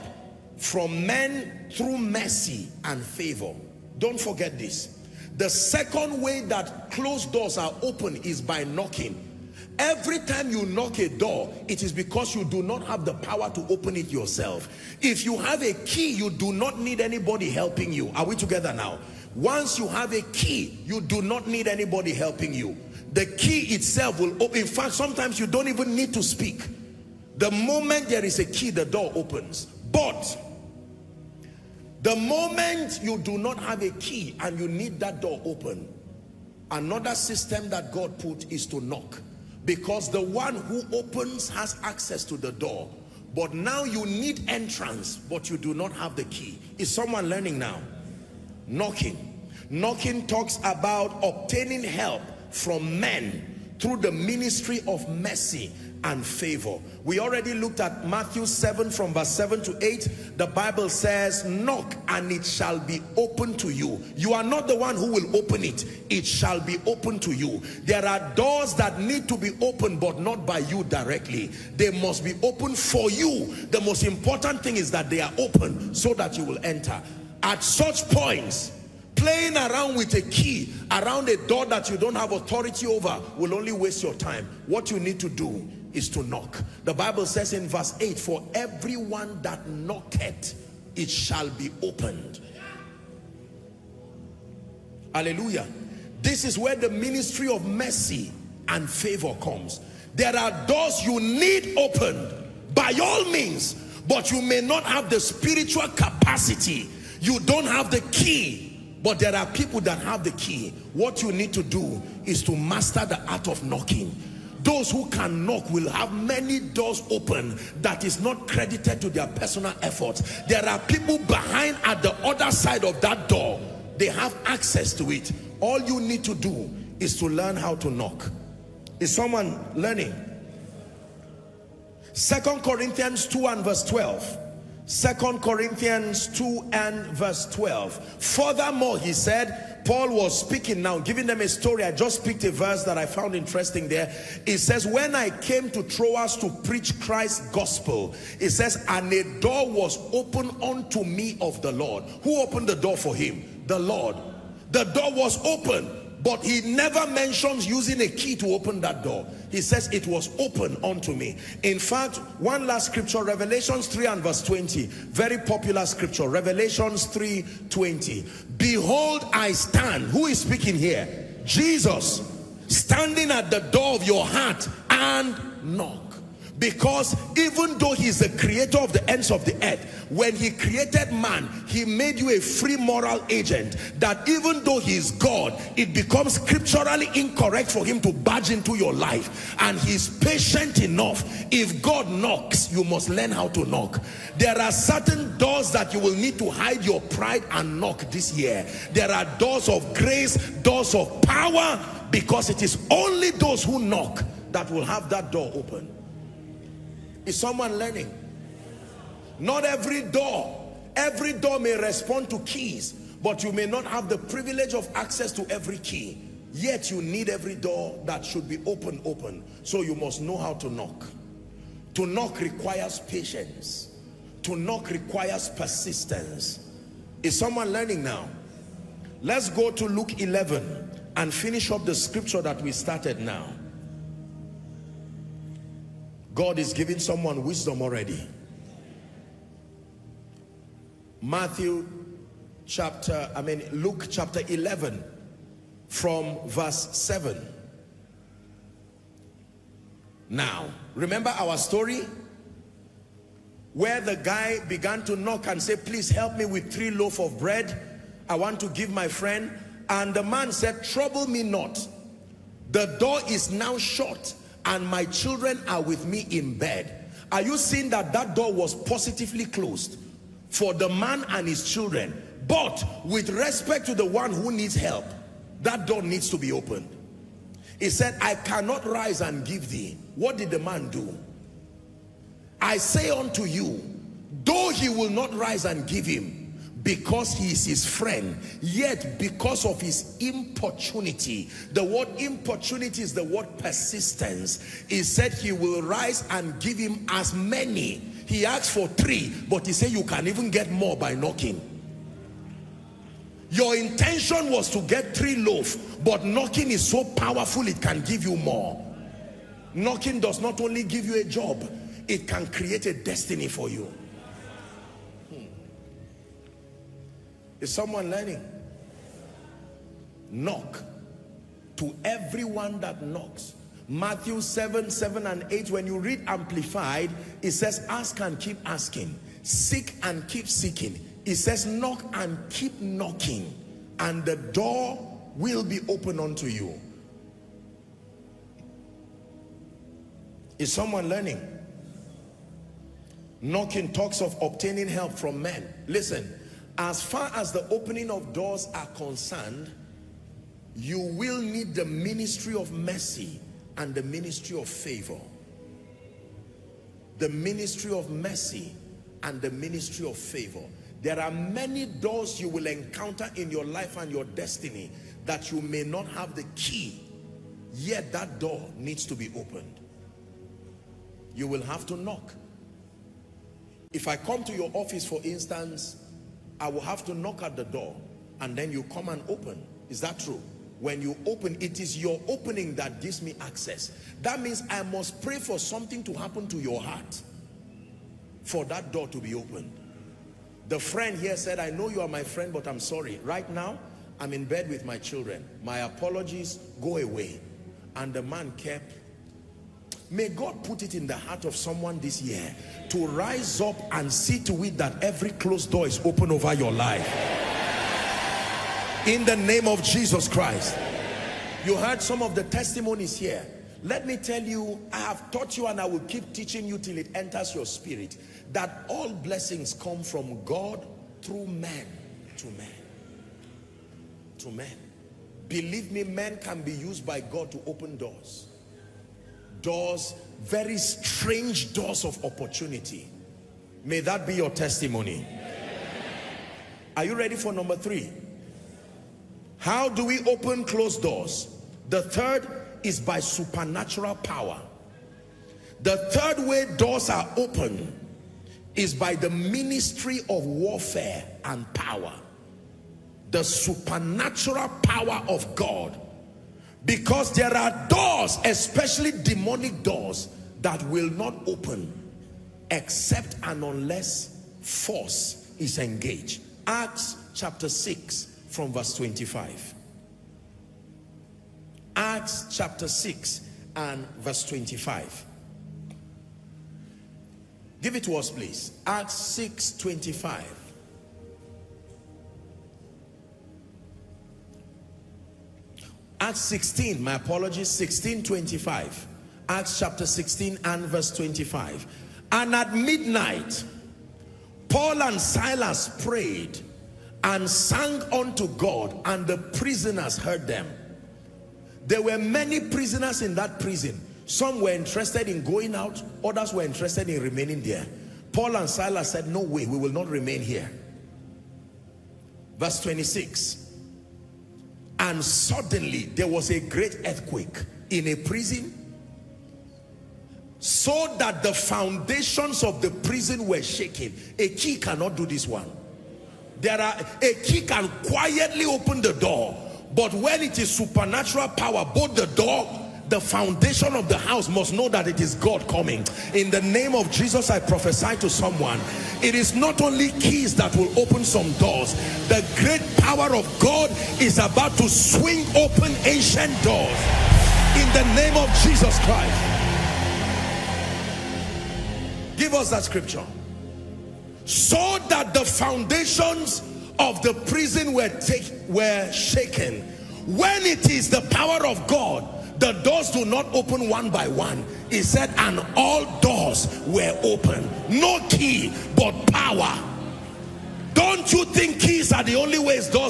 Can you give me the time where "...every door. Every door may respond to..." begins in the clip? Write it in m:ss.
3:29.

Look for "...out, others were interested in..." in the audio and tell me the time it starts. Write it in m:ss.
8:25.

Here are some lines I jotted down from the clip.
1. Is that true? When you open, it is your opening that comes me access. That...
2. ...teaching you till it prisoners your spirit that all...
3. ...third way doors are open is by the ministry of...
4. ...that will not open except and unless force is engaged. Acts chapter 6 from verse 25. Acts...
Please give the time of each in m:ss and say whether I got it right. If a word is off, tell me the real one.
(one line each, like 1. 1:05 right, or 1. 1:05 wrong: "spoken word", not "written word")
1. 6:19 wrong: "gives", not "comes"
2. 6:56 wrong: "enters", not "prisoners"
3. 7:26 right
4. 7:40 right.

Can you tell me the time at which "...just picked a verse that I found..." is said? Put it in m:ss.
2:21.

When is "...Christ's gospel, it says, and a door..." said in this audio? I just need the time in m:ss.
2:26.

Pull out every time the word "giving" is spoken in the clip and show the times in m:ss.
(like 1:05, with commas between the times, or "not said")
2:20, 3:56.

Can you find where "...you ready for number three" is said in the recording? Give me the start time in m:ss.
7:17.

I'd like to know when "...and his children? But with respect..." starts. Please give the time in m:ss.
4:31.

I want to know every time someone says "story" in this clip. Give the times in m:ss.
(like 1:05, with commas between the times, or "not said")
2:21, 4:11.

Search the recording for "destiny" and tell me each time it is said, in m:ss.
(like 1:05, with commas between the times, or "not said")
5:12, 6:04.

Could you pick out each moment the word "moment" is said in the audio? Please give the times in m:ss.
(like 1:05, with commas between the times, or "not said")
0:27, 0:32.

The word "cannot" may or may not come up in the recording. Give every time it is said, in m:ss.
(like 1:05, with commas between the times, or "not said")
4:38, 8:44.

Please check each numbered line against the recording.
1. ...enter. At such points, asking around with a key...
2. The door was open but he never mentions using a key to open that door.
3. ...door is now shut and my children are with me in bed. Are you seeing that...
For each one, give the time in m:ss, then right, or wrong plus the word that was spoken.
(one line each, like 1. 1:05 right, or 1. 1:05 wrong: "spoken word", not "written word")
1. 1:16 wrong: "playing", not "asking"
2. 2:34 right
3. 4:22 right.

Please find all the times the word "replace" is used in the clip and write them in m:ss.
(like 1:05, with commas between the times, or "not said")
not said.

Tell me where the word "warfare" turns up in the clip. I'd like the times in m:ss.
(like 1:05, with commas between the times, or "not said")
7:30.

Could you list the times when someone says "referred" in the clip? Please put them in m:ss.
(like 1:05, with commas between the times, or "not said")
not said.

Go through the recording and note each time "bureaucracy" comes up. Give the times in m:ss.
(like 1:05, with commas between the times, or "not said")
not said.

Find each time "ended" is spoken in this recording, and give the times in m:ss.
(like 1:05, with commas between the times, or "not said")
not said.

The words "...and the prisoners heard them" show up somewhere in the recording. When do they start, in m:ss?
8:19.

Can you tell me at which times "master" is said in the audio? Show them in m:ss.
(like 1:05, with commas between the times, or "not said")
1:52.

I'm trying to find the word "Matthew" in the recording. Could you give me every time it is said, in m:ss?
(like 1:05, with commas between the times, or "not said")
0:58, 4:01, 5:23.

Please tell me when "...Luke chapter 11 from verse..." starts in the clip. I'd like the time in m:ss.
4:03.